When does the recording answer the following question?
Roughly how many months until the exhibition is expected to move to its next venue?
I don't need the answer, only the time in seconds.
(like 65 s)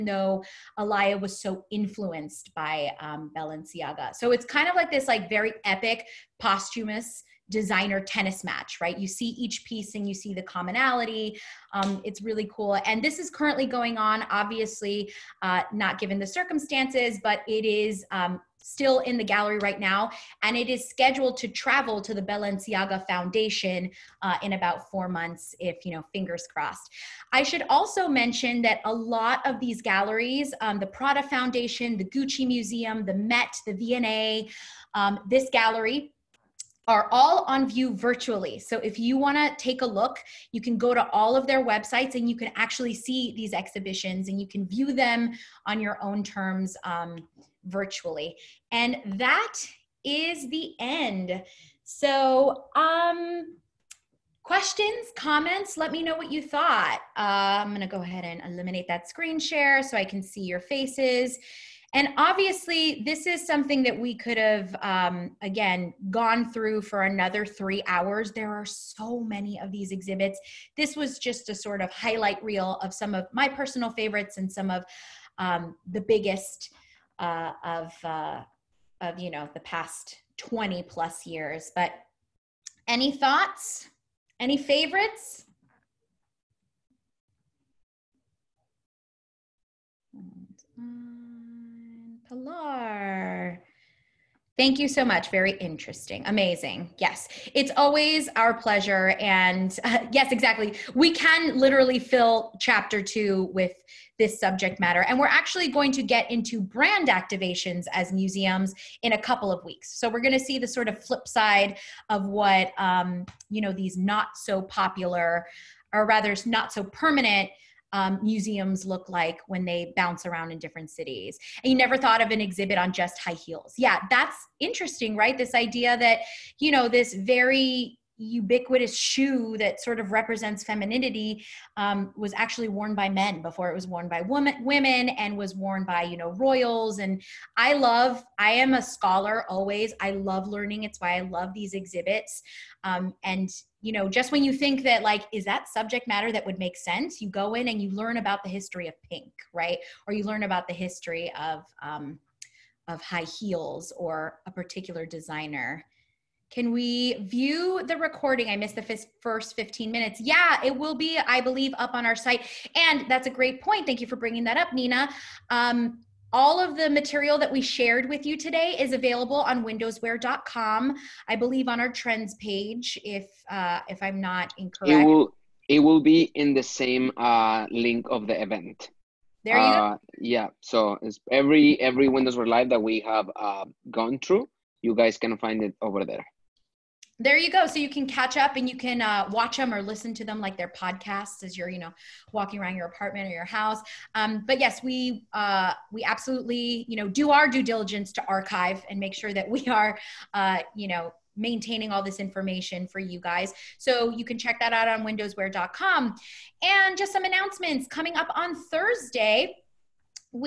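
24 s.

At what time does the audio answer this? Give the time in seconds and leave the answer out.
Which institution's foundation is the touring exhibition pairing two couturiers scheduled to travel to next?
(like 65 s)
22 s.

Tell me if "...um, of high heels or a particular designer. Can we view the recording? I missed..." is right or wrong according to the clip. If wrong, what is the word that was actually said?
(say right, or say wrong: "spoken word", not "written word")
right.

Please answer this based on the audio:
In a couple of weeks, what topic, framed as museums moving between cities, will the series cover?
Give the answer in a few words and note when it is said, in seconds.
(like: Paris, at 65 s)
brand activations, at 106 s.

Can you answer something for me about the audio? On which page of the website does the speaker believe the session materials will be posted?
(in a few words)
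trends page.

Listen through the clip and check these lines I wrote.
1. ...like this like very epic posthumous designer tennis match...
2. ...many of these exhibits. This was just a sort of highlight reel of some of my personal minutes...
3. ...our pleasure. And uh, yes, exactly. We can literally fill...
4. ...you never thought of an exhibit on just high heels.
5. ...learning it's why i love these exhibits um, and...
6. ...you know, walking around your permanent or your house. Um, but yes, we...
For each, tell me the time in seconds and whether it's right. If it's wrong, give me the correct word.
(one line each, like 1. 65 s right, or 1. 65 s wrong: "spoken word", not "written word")
1. 4 s right
2. 69 s wrong: "favorites", not "minutes"
3. 98 s right
4. 121 s right
5. 140 s right
6. 191 s wrong: "apartment", not "permanent".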